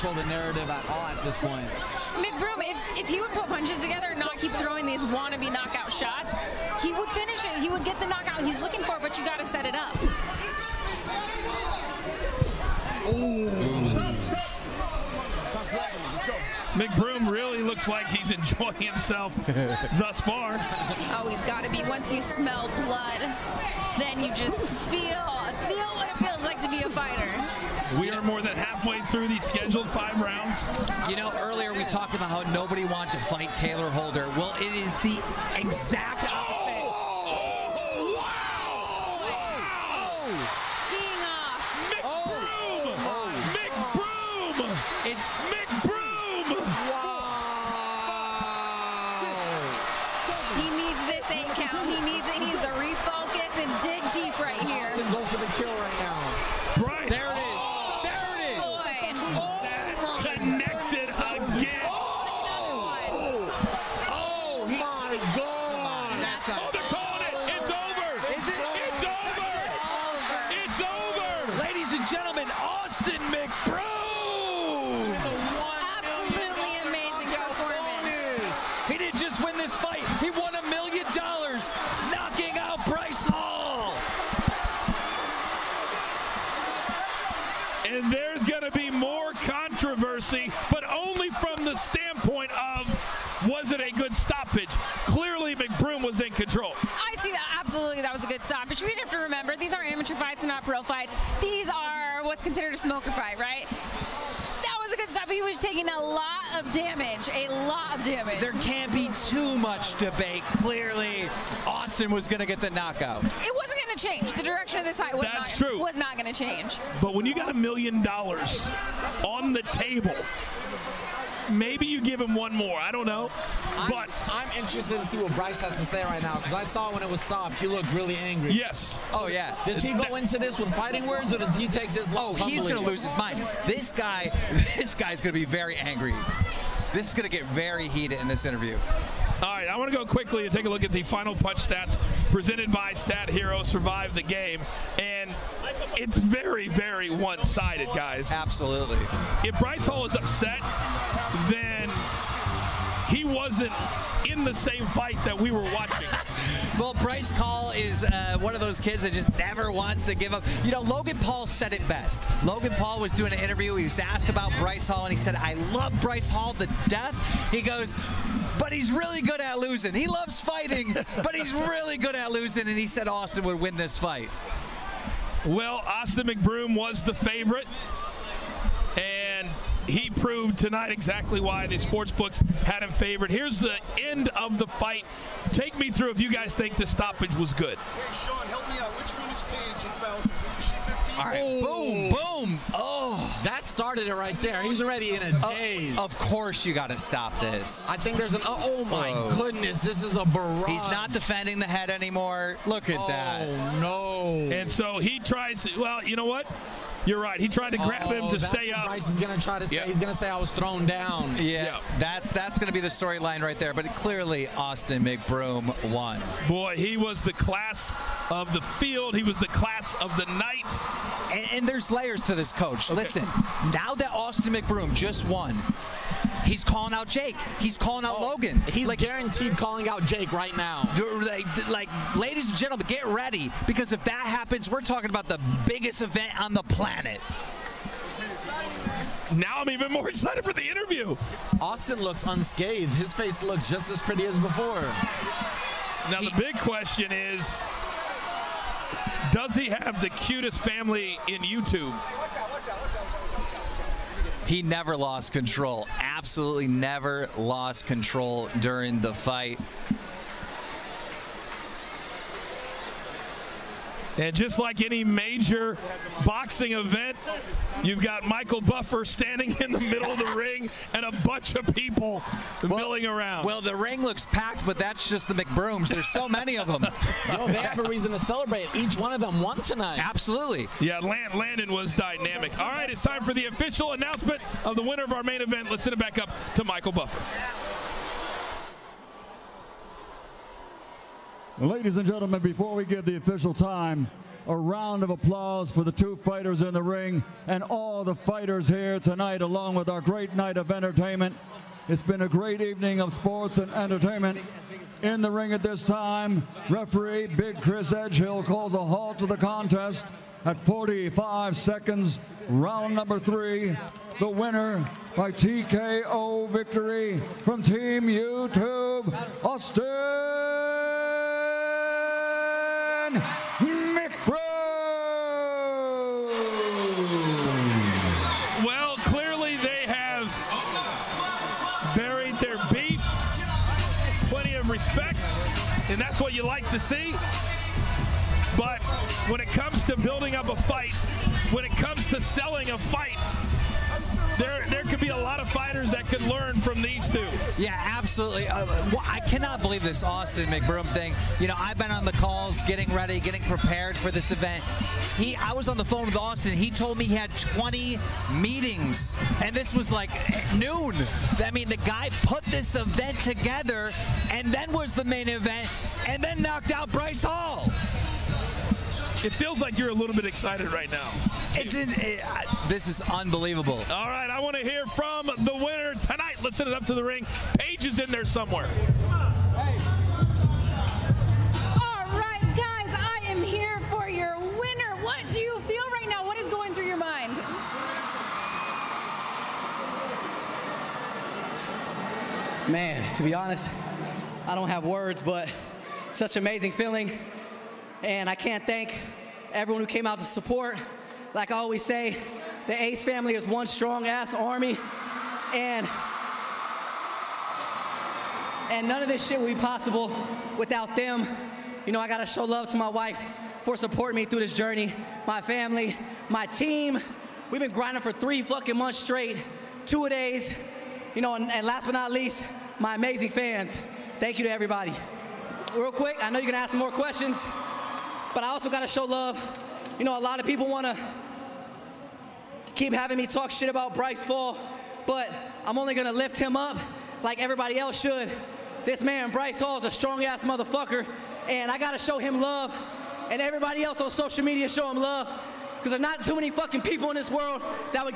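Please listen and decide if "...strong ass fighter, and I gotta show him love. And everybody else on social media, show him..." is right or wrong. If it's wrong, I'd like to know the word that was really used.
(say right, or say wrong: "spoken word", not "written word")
wrong: "motherfucker", not "fighter".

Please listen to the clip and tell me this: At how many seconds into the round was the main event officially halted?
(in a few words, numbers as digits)
45 seconds.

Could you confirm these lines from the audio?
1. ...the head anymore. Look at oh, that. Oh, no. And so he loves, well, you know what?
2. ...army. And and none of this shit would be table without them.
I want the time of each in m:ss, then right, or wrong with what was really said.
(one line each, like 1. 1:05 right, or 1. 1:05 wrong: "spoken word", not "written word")
1. 3:21 wrong: "tries", not "loves"
2. 6:44 wrong: "possible", not "table".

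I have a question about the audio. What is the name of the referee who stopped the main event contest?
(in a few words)
Big Chris Edgehill.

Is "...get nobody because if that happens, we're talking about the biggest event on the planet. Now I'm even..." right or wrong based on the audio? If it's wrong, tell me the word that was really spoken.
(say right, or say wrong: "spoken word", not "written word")
wrong: "ready", not "nobody".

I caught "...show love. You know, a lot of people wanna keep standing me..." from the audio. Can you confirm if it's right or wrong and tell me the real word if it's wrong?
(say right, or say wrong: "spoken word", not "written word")
wrong: "having", not "standing".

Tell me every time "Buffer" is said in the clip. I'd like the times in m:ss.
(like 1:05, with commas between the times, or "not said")
4:28, 4:46.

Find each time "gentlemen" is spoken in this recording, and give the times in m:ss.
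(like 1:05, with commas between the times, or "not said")
3:52, 4:52.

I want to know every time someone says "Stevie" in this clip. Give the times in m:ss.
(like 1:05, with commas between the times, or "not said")
not said.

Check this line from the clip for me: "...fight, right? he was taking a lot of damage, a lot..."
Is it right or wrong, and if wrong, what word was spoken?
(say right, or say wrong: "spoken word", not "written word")
right.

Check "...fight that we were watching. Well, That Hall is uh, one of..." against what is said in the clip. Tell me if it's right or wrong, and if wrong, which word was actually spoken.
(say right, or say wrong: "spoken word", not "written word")
wrong: "Bryce", not "That".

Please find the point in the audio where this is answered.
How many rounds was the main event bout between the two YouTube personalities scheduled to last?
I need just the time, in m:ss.
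0:29.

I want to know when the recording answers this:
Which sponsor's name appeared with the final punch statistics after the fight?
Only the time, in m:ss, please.
2:22.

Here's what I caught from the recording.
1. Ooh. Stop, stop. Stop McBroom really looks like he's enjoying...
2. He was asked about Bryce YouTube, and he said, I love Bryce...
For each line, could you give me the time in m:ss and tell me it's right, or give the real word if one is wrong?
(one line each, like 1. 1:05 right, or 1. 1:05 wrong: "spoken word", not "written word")
1. 0:13 right
2. 2:43 wrong: "Hall", not "YouTube".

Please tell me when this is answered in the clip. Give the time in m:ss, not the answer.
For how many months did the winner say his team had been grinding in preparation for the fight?
6:58.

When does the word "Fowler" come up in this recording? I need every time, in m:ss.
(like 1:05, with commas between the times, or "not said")
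3:09.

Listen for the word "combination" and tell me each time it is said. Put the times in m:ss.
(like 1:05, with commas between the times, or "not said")
not said.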